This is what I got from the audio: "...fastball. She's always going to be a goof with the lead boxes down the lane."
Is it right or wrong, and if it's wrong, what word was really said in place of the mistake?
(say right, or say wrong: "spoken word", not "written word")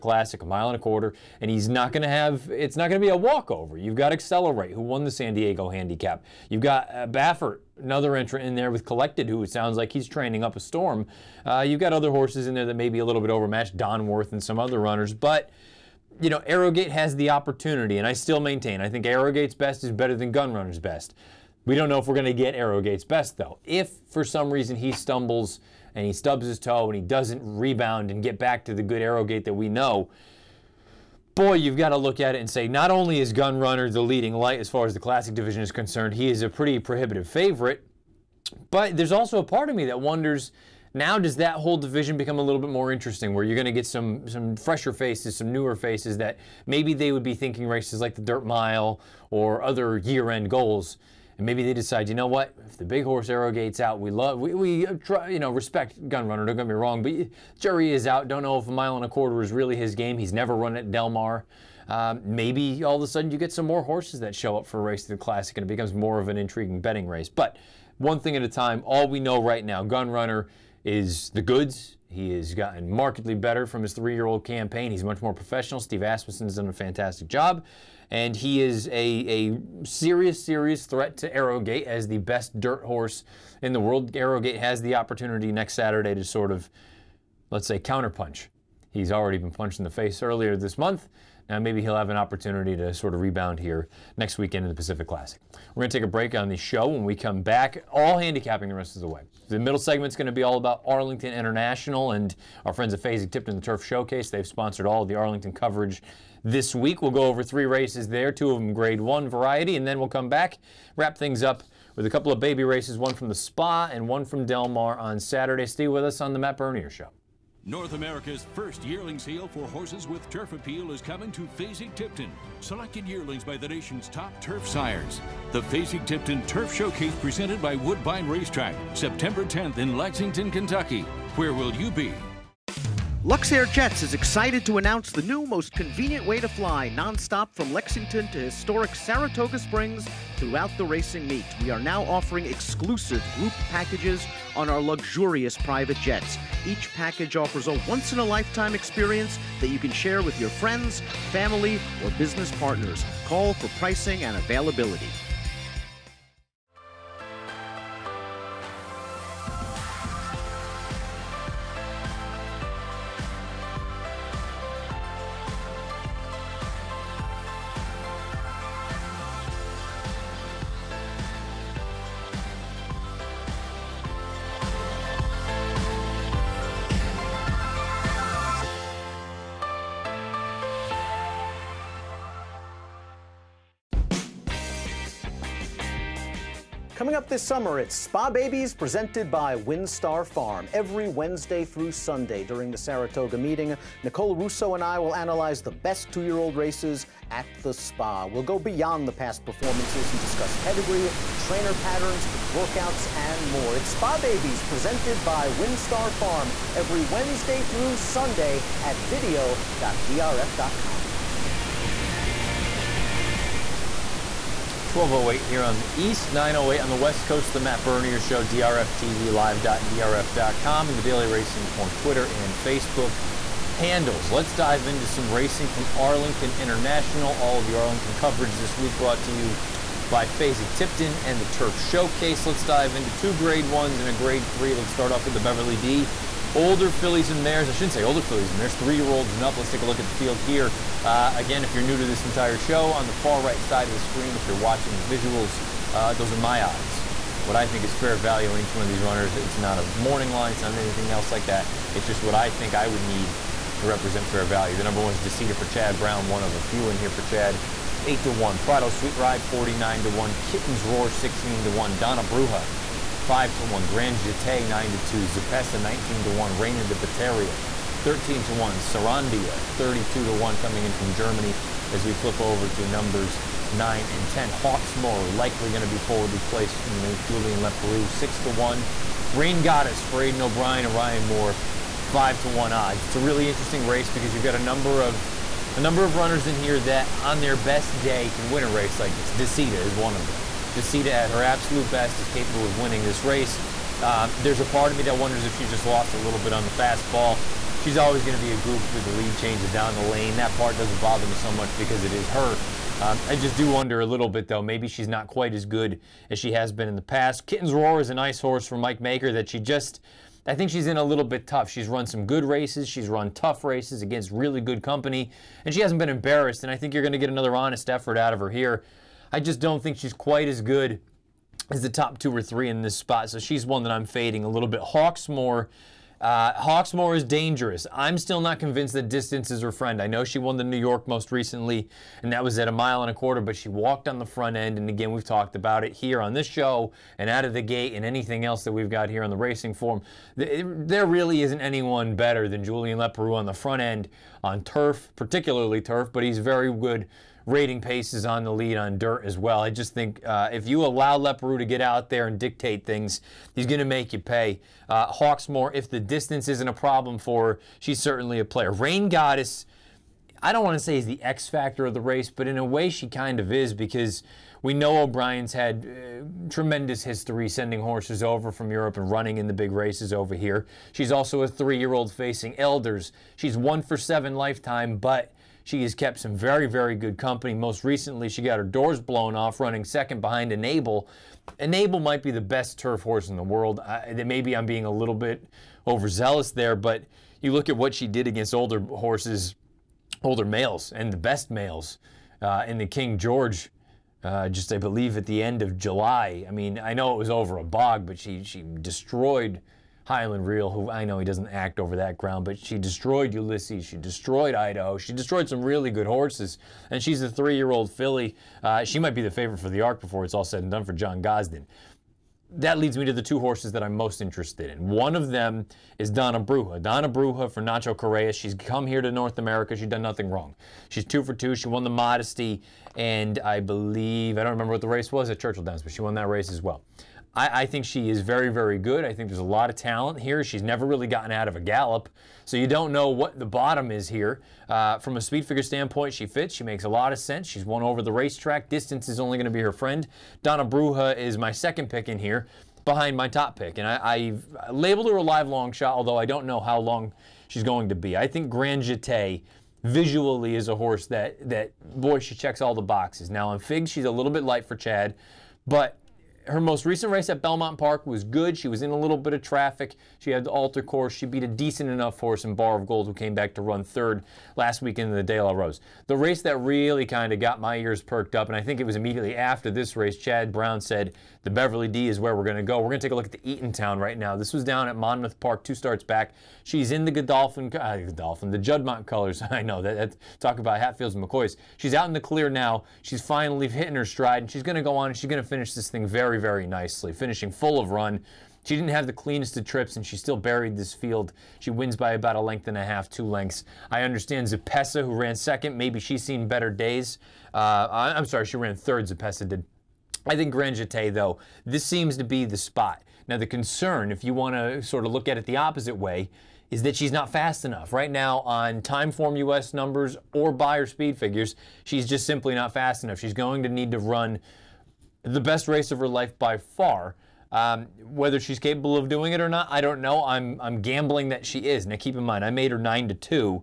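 wrong: "changes", not "boxes".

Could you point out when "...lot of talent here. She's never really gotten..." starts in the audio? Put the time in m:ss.
7:09.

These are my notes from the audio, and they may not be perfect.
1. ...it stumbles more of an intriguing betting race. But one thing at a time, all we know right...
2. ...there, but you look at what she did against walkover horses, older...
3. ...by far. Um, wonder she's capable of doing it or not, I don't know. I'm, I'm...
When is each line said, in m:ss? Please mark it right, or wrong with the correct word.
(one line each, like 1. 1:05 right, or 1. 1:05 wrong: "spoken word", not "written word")
1. 1:05 wrong: "becomes", not "stumbles"
2. 6:26 wrong: "older", not "walkover"
3. 8:36 wrong: "whether", not "wonder".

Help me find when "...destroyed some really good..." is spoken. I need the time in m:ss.
6:45.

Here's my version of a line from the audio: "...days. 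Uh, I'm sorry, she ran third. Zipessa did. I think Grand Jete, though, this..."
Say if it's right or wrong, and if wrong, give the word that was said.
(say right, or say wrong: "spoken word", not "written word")
right.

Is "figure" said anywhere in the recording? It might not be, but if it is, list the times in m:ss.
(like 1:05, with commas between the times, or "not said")
7:15, 8:31.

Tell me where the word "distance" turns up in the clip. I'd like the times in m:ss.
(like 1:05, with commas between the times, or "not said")
5:29, 5:55, 7:18.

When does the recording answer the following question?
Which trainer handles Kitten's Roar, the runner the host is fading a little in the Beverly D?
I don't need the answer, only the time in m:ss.
5:08.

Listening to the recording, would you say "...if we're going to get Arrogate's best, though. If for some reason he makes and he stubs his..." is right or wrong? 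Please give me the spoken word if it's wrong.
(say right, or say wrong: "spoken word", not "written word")
wrong: "stumbles", not "makes".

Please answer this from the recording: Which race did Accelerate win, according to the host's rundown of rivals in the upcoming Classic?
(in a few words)
San Diego Handicap.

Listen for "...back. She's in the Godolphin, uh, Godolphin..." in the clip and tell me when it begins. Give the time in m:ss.
7:56.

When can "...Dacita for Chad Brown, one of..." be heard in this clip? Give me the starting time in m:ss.
4:15.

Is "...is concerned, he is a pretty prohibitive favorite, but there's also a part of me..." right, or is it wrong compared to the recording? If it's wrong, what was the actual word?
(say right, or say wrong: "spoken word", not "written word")
right.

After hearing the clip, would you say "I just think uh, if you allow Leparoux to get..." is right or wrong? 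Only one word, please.
right.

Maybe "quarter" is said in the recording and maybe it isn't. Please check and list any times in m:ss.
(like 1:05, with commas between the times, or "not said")
0:00, 0:59, 5:33.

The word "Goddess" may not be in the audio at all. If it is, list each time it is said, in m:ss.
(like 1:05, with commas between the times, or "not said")
4:39, 5:59.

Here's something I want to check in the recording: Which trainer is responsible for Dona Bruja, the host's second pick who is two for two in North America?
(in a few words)
Nacho Correa.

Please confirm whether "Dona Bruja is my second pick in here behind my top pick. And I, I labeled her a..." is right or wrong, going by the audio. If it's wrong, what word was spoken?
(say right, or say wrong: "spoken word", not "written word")
right.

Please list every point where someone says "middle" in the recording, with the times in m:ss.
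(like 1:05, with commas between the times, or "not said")
1:39.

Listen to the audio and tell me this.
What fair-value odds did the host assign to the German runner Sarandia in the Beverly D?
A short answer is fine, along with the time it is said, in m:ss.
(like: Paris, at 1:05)
32 to 1, at 4:29.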